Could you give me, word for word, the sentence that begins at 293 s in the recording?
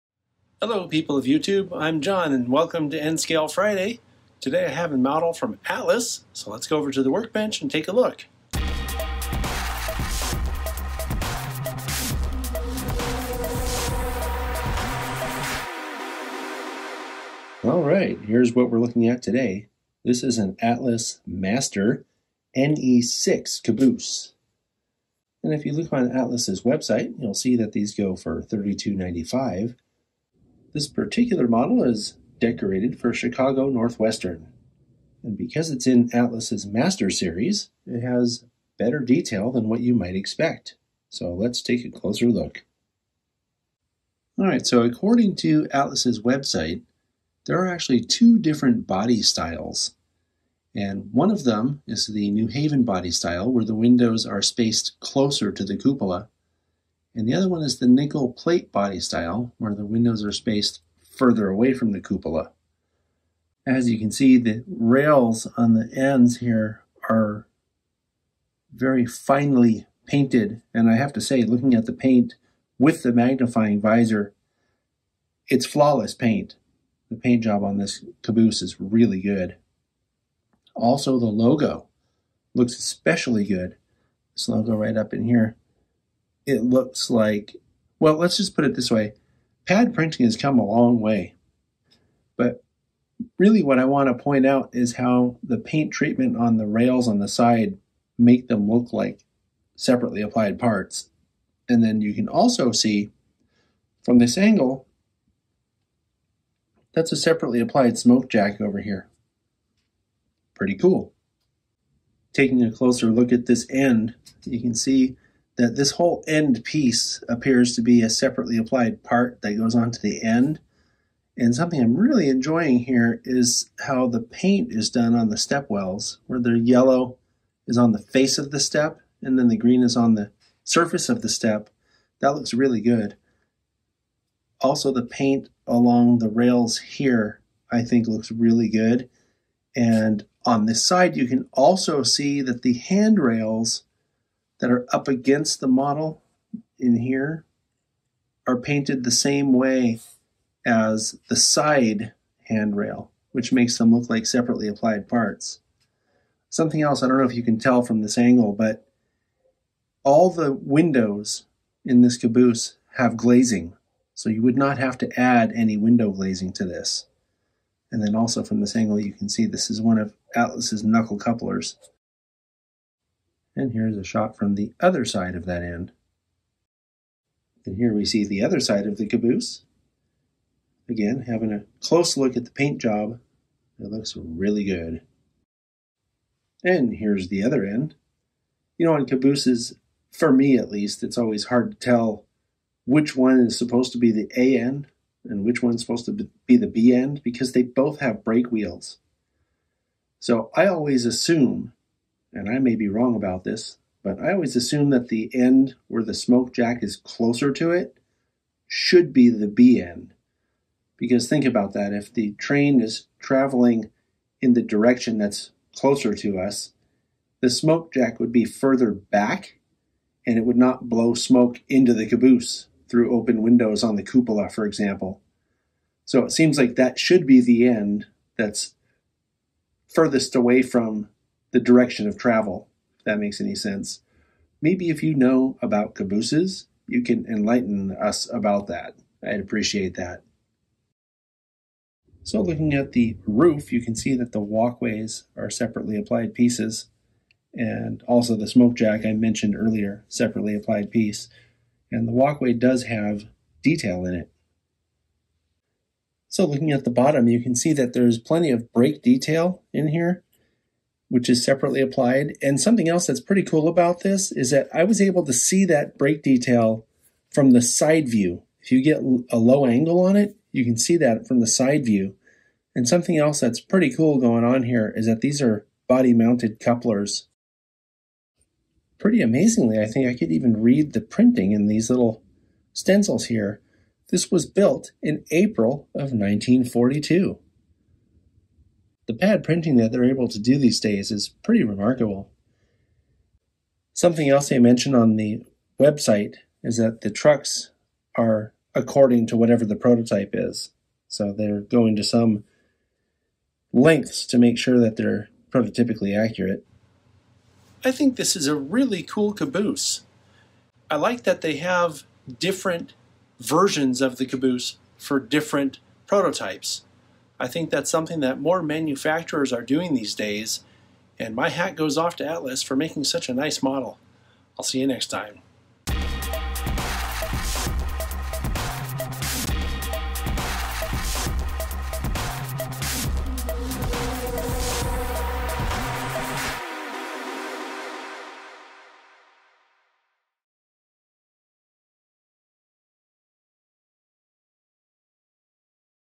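Something else they mention on the website is that the trucks are according to whatever the prototype is.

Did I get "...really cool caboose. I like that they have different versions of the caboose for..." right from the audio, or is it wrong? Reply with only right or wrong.
right.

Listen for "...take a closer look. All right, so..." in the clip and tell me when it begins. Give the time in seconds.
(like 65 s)
41 s.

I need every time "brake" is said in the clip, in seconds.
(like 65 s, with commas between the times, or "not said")
198 s, 258 s, 265 s.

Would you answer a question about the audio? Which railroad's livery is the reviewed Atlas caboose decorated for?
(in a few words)
Chicago Northwestern.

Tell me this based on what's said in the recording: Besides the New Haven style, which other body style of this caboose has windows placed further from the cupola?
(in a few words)
Nickel Plate.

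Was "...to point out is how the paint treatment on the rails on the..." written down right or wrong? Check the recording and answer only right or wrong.
right.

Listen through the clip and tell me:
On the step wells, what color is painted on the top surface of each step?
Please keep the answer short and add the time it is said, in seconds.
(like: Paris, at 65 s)
Green, at 129 s.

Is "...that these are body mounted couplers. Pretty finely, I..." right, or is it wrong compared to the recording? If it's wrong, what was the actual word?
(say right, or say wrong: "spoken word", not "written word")
wrong: "amazingly", not "finely".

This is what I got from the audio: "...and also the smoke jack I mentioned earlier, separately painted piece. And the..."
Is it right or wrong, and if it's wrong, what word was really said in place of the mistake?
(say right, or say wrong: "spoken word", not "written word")
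wrong: "applied", not "painted".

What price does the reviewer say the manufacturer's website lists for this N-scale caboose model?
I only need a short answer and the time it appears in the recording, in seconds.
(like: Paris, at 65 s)
$32.95, at 28 s.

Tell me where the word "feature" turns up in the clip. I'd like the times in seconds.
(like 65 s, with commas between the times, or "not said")
not said.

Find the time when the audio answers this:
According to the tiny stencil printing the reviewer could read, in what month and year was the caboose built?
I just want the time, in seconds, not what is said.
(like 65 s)
285 s.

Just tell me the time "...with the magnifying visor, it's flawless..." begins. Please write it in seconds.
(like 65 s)
72 s.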